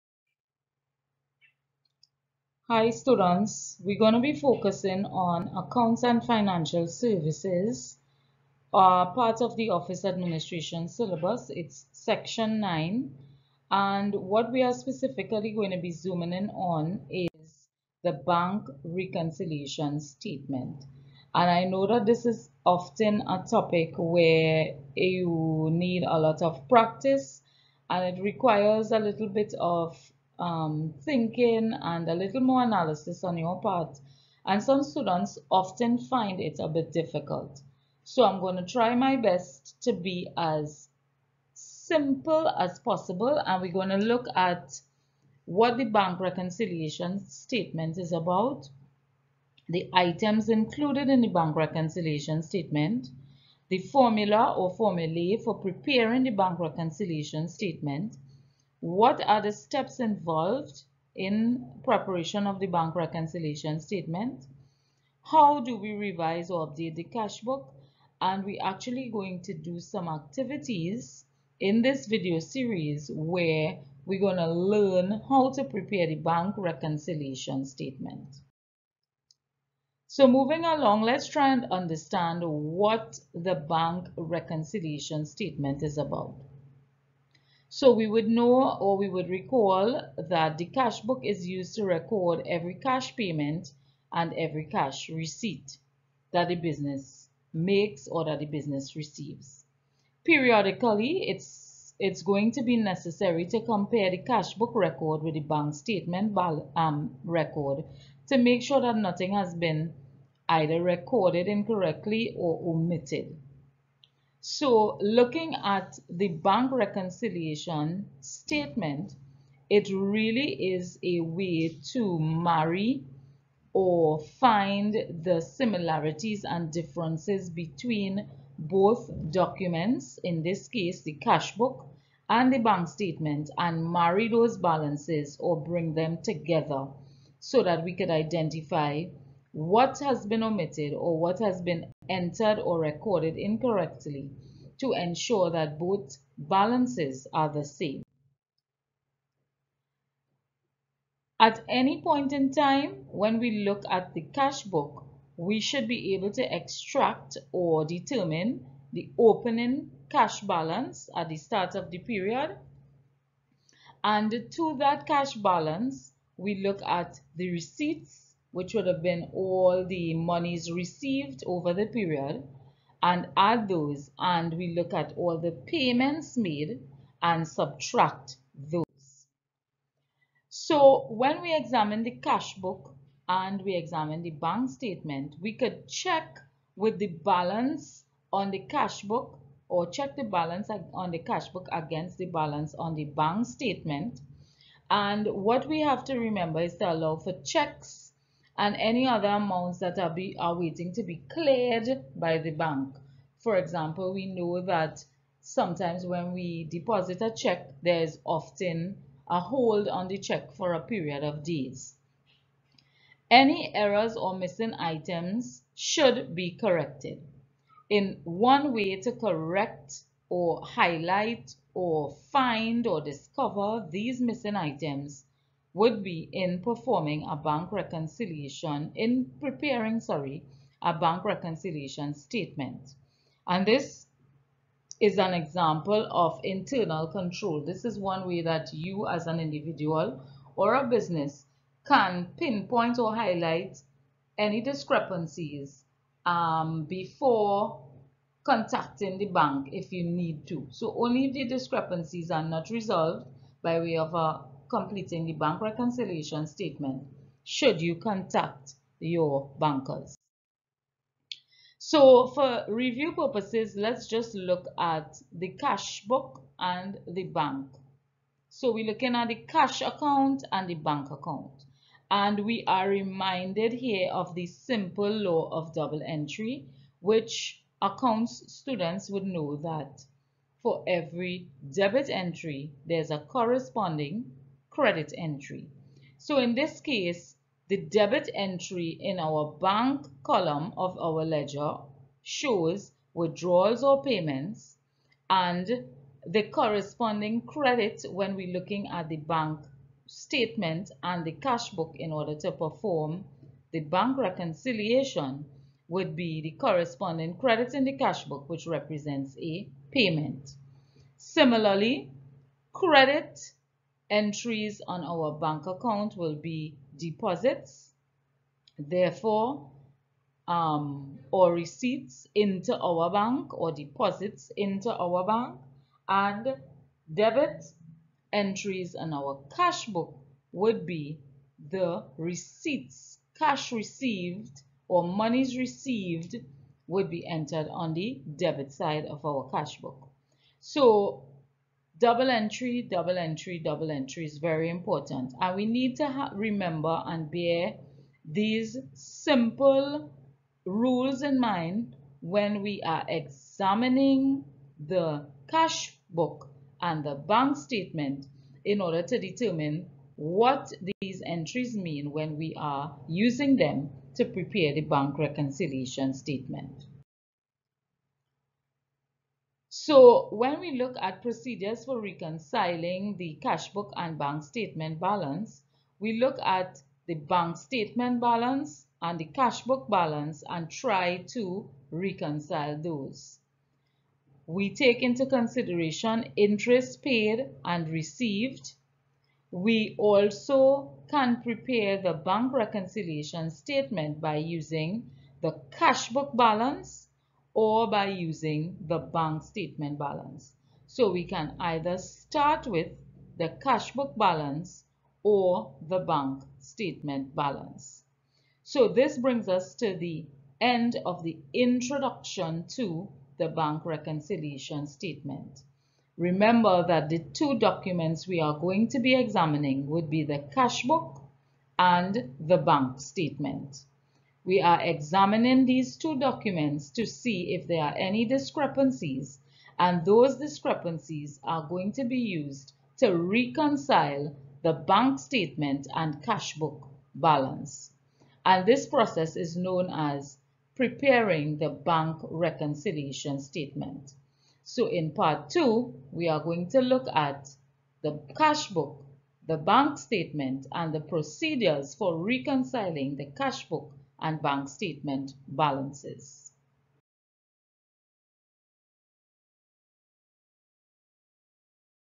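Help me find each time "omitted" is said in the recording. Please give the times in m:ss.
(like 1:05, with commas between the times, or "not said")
1:52, 2:20.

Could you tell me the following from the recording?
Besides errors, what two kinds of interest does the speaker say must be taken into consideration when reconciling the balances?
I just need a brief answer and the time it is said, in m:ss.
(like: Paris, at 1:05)
paid and received, at 6:26.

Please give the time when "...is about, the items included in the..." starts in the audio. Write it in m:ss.
0:47.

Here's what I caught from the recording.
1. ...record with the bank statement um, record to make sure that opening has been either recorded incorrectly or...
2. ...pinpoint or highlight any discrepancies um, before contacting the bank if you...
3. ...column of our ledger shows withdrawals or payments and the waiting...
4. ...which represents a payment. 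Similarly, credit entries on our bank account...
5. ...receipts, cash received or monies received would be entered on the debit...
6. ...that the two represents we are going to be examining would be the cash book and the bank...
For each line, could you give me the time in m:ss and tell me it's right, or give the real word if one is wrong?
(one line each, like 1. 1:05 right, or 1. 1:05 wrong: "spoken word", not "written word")
1. 1:44 wrong: "nothing", not "opening"
2. 4:02 right
3. 4:50 wrong: "corresponding", not "waiting"
4. 5:08 right
5. 5:32 right
6. 6:56 wrong: "documents", not "represents".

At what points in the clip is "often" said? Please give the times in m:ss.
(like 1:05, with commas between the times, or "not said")
0:22, 0:35, 3:28.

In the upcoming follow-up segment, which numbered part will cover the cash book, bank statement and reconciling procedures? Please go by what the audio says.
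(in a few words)
part two.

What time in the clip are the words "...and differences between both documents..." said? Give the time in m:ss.
2:06.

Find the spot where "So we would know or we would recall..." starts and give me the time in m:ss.
1:27.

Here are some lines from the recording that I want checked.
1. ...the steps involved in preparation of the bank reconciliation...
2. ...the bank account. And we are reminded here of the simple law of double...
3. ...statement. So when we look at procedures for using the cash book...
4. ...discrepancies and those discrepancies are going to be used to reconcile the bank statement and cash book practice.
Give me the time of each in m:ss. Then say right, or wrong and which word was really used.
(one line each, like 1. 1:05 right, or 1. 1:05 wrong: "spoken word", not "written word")
1. 0:59 right
2. 4:30 right
3. 6:06 wrong: "reconciling", not "using"
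4. 7:08 wrong: "balance", not "practice".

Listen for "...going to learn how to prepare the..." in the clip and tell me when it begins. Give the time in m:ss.
1:14.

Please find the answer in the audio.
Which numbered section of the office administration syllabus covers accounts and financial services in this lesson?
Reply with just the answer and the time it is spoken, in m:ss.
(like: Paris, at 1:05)
9, at 0:11.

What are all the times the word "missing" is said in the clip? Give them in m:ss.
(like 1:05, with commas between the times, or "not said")
3:34, 3:44.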